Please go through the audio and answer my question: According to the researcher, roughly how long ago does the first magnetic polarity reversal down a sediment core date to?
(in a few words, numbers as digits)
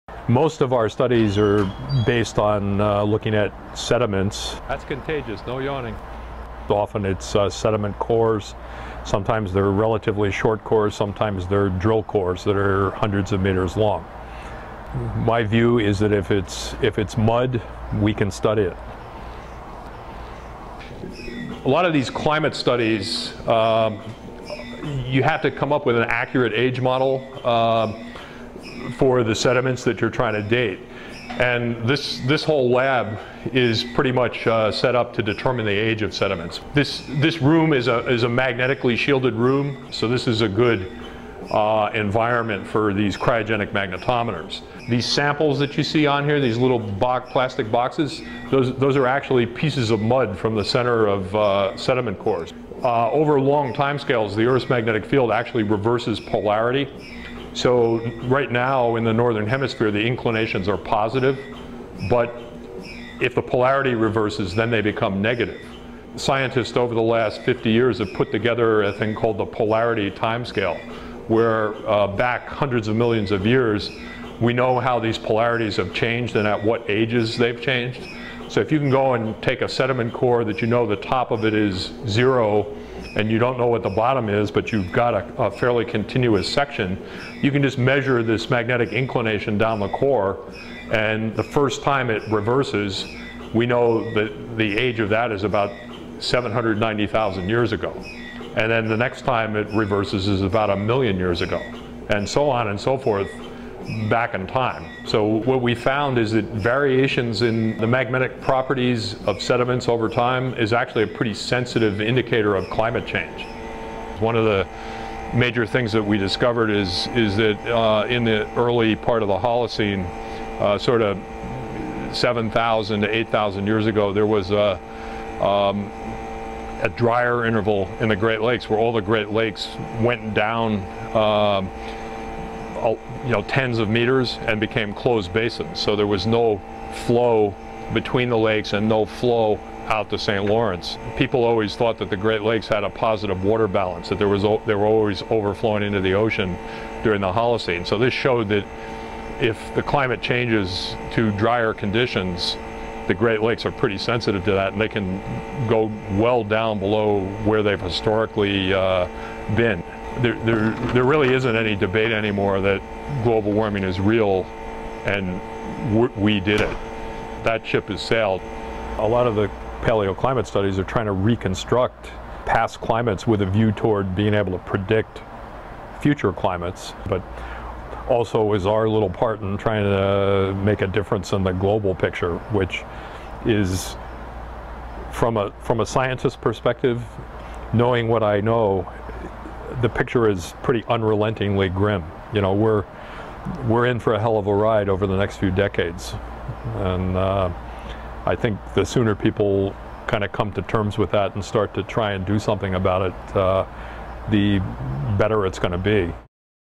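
790,000 years ago.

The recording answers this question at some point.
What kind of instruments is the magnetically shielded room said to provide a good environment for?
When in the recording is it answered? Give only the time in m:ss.
0:43.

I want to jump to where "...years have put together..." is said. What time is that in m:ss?
1:07.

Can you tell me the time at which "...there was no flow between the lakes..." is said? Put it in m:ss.
2:15.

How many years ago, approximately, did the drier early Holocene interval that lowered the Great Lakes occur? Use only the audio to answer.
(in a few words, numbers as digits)
7,000 to 8,000 years.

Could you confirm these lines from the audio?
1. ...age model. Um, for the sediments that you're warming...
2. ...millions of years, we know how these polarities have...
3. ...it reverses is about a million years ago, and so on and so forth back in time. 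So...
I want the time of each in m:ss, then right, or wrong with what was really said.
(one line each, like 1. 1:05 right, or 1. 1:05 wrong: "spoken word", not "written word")
1. 0:26 wrong: "trying", not "warming"
2. 1:12 right
3. 1:39 right.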